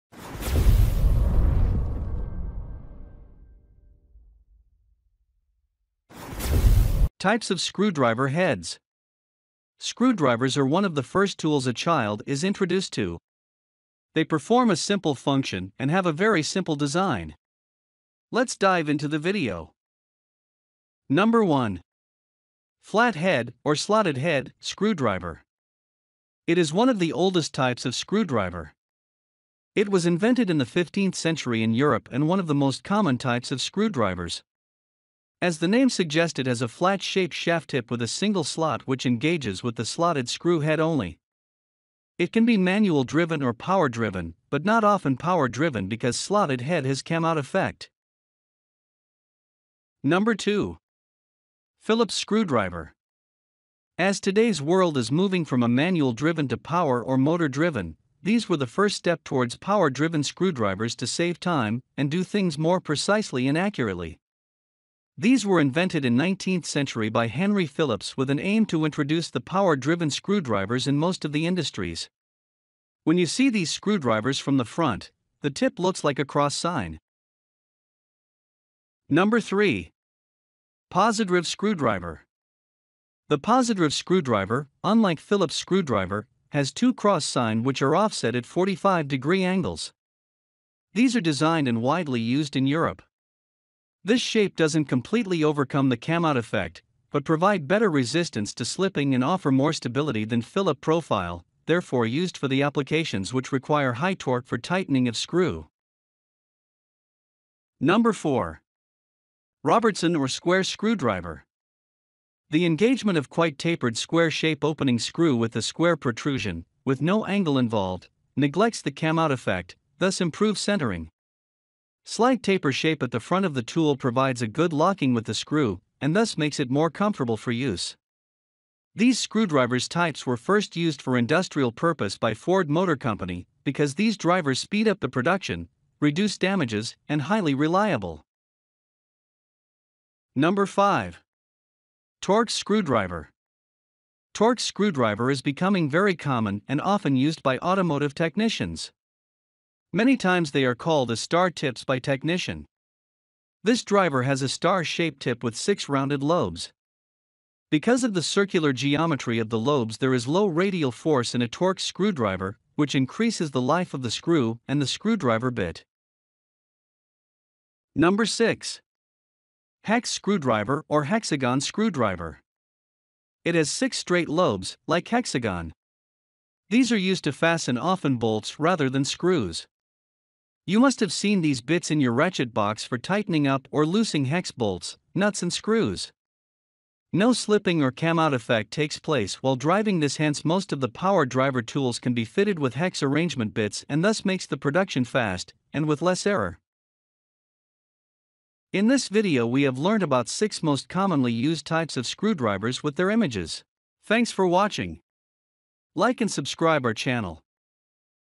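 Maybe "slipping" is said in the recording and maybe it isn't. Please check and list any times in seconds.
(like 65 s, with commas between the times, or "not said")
98 s, 187 s.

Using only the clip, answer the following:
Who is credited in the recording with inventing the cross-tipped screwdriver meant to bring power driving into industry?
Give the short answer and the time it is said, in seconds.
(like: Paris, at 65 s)
Henry Phillips, at 67 s.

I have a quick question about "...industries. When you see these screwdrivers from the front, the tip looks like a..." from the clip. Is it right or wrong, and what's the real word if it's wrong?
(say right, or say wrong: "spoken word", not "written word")
right.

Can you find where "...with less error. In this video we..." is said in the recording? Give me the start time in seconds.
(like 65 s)
195 s.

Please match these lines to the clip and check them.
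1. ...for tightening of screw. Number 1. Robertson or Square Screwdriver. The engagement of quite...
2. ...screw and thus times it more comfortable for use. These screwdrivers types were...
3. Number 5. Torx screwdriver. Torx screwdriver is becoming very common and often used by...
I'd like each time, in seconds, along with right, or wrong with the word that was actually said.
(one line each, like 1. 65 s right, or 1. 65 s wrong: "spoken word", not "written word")
1. 104 s wrong: "4", not "1"
2. 125 s wrong: "makes", not "times"
3. 140 s right.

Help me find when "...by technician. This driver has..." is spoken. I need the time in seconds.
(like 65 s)
151 s.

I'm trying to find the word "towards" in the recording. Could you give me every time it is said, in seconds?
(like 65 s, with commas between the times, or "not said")
59 s.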